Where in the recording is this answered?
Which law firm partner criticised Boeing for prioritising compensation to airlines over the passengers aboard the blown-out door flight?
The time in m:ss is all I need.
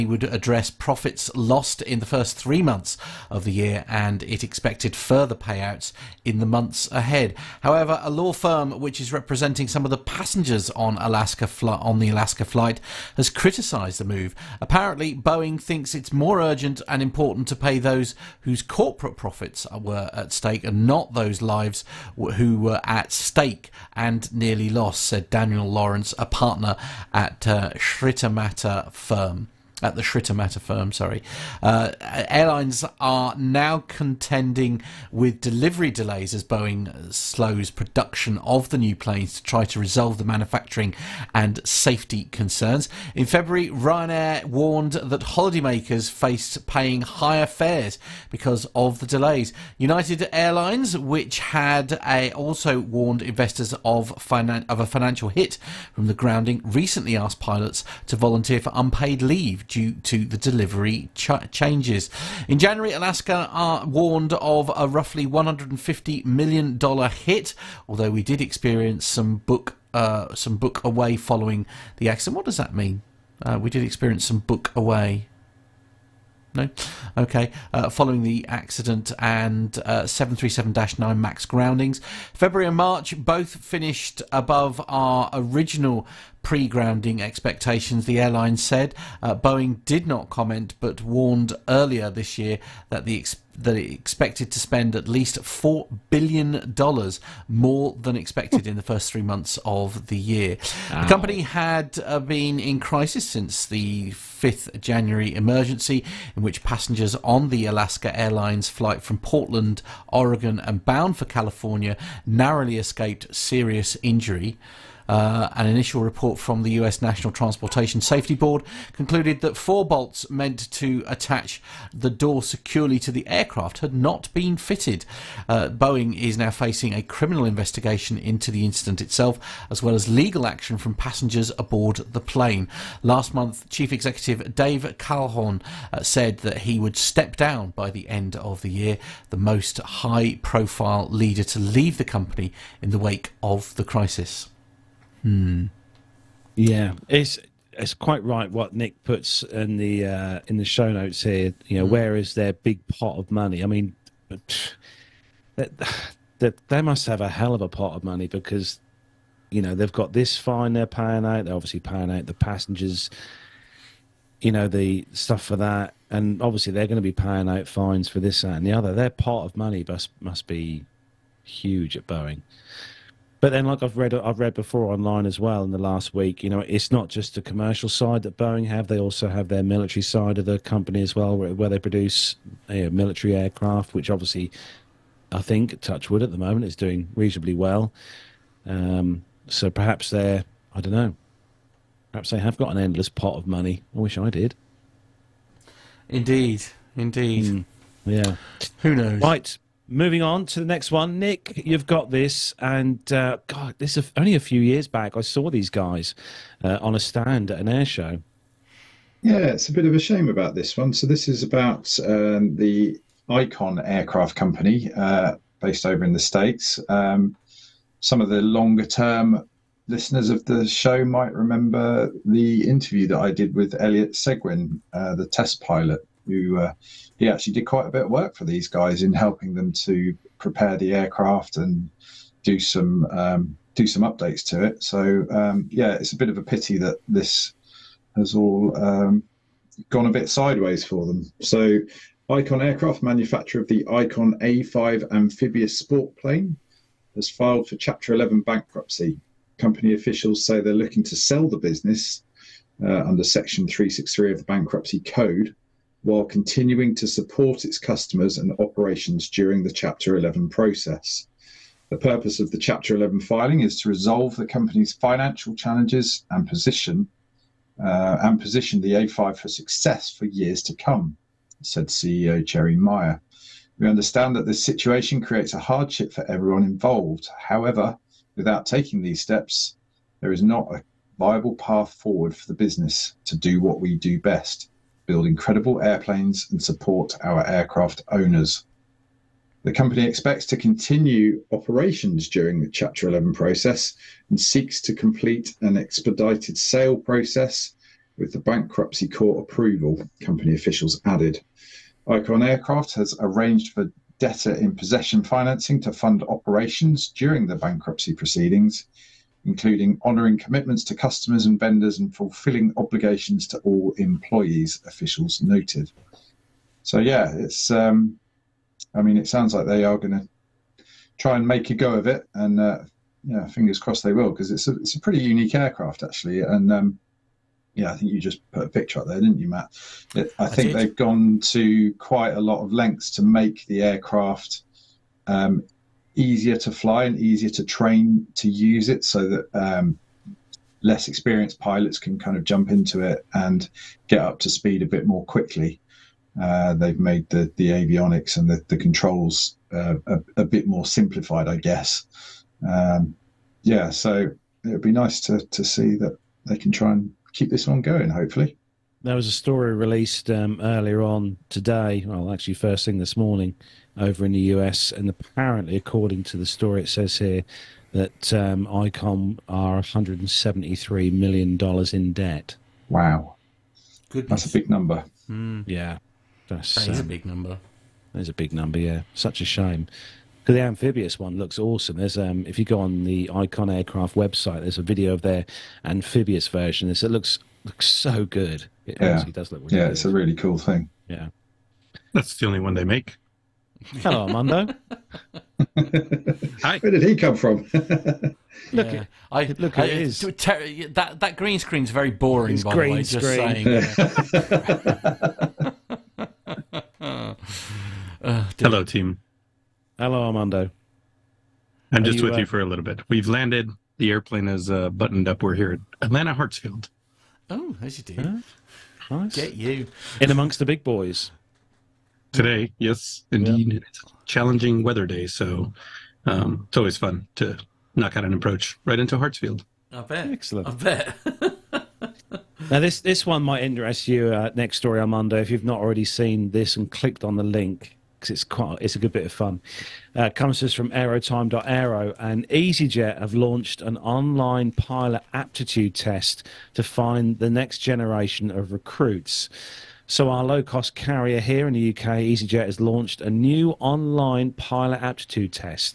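0:25.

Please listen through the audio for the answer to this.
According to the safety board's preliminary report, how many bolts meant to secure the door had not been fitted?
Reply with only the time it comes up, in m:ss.
1:59.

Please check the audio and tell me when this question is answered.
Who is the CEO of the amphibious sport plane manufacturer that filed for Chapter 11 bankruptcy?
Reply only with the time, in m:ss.
4:32.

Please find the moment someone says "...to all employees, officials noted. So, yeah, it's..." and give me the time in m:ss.
5:13.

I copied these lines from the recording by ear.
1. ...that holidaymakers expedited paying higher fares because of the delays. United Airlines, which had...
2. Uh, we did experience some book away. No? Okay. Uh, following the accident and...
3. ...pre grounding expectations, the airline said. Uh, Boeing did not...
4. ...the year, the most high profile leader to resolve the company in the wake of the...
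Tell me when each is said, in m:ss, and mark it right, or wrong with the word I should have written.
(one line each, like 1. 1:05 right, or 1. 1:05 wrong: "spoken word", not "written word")
1. 0:44 wrong: "faced", not "expedited"
2. 1:13 right
3. 1:26 right
4. 2:18 wrong: "leave", not "resolve".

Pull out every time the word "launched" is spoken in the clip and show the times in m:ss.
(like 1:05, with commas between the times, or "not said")
7:23, 7:32.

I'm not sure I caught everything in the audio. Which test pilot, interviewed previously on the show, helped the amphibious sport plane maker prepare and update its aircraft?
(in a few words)
Elliot Seguin.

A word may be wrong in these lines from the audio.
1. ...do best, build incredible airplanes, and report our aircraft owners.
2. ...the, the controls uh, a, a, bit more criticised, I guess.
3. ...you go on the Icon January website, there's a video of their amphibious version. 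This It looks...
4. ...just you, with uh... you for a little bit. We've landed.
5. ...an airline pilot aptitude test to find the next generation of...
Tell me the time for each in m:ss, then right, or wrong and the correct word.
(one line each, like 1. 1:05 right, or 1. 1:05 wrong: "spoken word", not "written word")
1. 4:43 wrong: "support", not "report"
2. 5:48 wrong: "simplified", not "criticised"
3. 6:22 wrong: "Aircraft", not "January"
4. 6:52 right
5. 7:23 wrong: "online", not "airline".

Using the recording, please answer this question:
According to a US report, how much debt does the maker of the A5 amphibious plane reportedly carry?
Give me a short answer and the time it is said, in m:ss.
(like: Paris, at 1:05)
$173 million, at 6:09.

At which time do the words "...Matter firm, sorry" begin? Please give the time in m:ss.
0:30.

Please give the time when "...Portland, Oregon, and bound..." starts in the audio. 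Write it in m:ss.
1:49.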